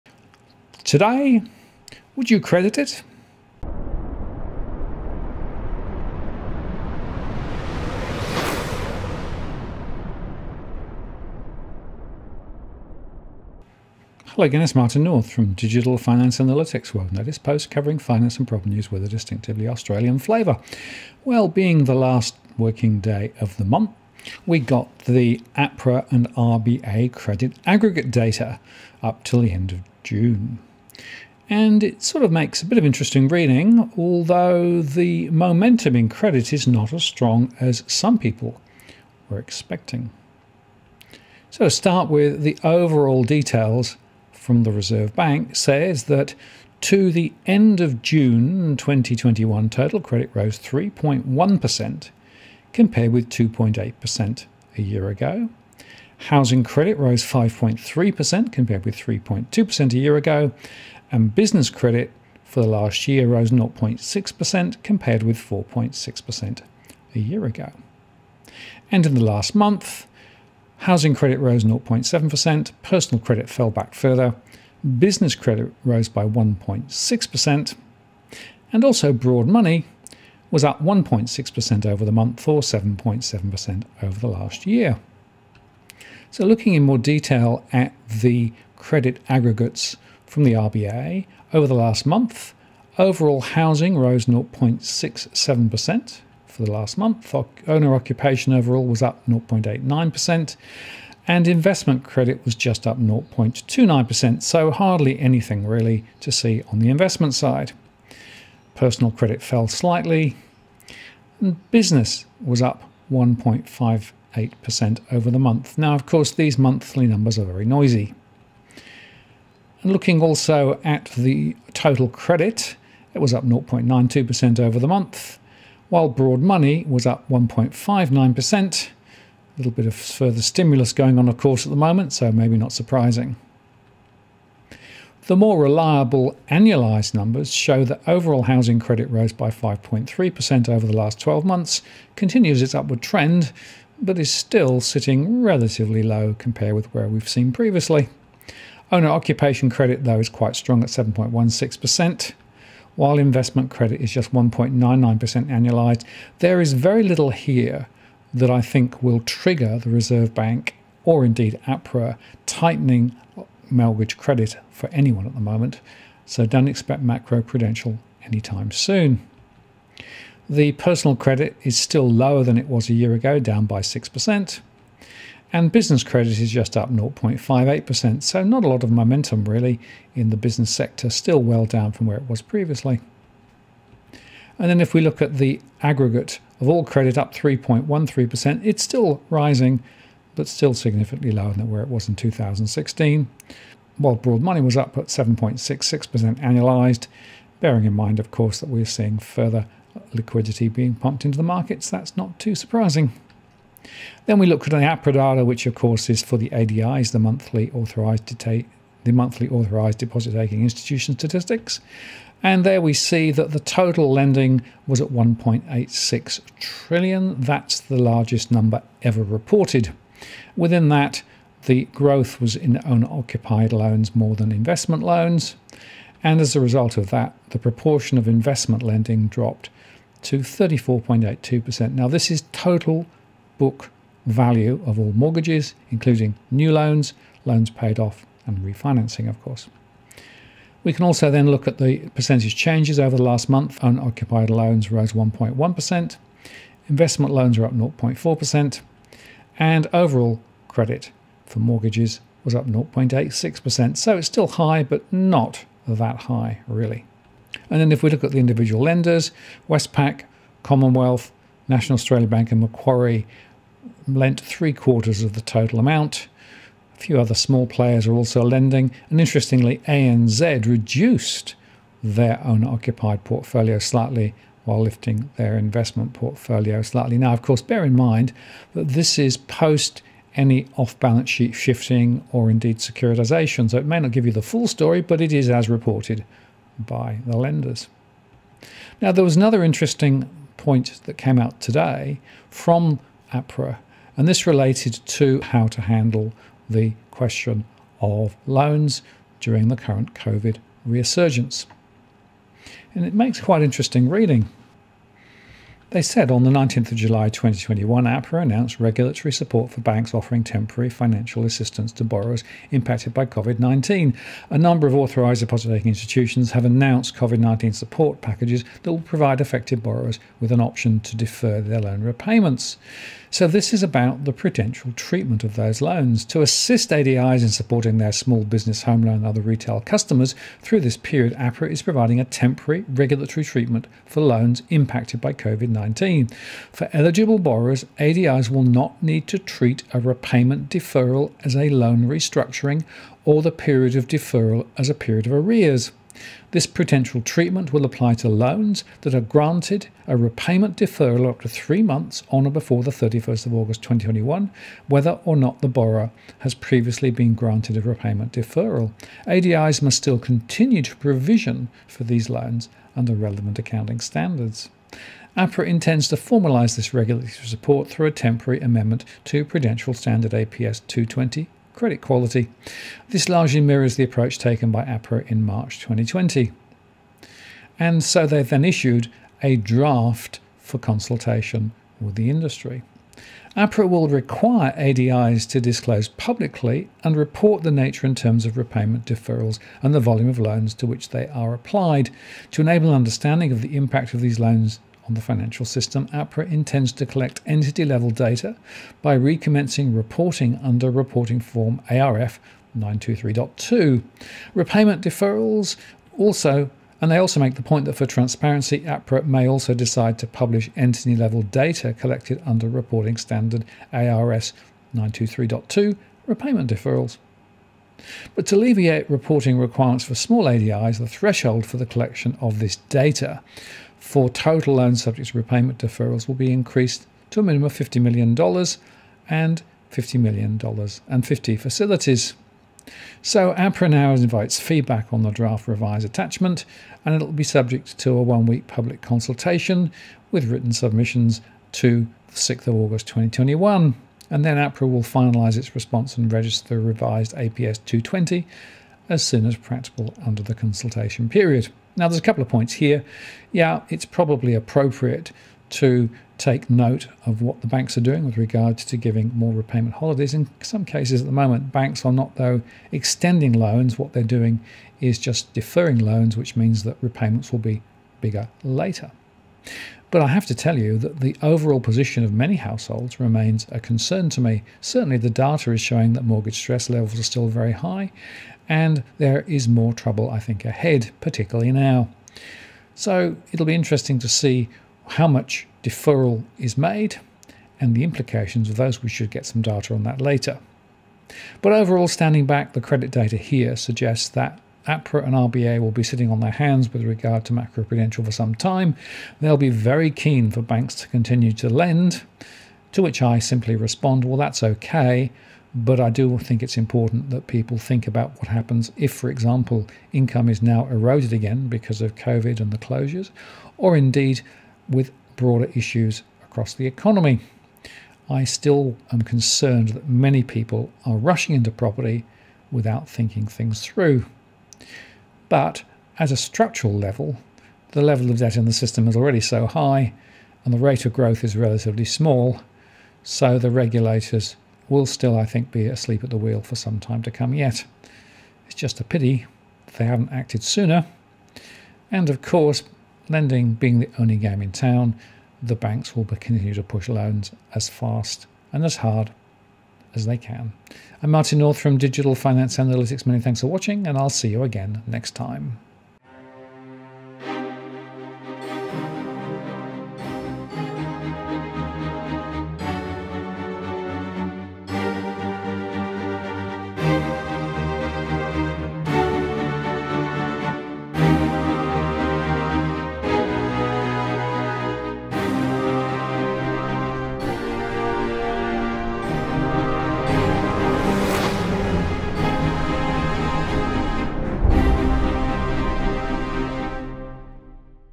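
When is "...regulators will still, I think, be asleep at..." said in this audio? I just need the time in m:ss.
8:53.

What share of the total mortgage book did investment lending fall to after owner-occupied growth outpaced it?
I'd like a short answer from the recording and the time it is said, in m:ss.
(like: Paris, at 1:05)
34.82%, at 3:50.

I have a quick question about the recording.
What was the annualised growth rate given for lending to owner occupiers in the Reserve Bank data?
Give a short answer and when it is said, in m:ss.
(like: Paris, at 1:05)
7.16%, at 2:30.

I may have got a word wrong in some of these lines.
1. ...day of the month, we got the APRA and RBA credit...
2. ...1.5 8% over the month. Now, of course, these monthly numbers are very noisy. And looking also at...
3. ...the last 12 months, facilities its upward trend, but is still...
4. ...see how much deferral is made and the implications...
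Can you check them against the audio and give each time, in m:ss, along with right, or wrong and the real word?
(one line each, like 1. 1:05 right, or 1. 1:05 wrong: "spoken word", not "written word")
1. 0:22 right
2. 1:53 right
3. 2:20 wrong: "continues", not "facilities"
4. 8:04 right.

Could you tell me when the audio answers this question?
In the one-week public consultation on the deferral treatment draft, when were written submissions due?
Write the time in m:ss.
7:22.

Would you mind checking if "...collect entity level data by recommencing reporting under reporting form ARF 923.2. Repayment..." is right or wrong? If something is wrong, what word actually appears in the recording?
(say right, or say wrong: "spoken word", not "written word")
right.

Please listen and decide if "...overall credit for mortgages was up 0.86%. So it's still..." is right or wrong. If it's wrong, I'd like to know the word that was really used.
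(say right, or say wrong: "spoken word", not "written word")
right.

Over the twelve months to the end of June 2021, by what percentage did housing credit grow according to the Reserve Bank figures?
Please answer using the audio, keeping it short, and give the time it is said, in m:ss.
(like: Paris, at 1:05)
5.3%, at 0:56.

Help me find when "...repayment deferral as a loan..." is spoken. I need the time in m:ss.
5:40.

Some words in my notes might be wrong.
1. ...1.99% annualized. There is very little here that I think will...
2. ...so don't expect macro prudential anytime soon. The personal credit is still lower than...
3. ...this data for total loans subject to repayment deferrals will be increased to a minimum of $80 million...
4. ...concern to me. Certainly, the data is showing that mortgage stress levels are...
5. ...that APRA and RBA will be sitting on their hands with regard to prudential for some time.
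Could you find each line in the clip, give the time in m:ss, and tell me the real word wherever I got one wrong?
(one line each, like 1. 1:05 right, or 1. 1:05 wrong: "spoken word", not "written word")
1. 2:34 right
2. 2:46 right
3. 7:02 wrong: "50", not "80"
4. 7:53 right
5. 8:14 wrong: "macroprudential", not "prudential".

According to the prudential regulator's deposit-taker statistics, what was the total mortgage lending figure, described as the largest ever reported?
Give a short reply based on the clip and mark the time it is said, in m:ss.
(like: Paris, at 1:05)
1.86 trillion, at 3:35.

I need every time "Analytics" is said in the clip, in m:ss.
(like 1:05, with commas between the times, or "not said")
0:16, 9:12.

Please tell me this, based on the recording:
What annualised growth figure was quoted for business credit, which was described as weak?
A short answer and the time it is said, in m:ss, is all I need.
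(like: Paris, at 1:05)
0.58%, at 2:56.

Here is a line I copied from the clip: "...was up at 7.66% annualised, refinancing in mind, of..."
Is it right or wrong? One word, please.
wrong.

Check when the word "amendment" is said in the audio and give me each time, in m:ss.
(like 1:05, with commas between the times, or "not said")
6:08.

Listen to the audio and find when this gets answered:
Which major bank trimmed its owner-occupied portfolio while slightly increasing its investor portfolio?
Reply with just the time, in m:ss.
4:29.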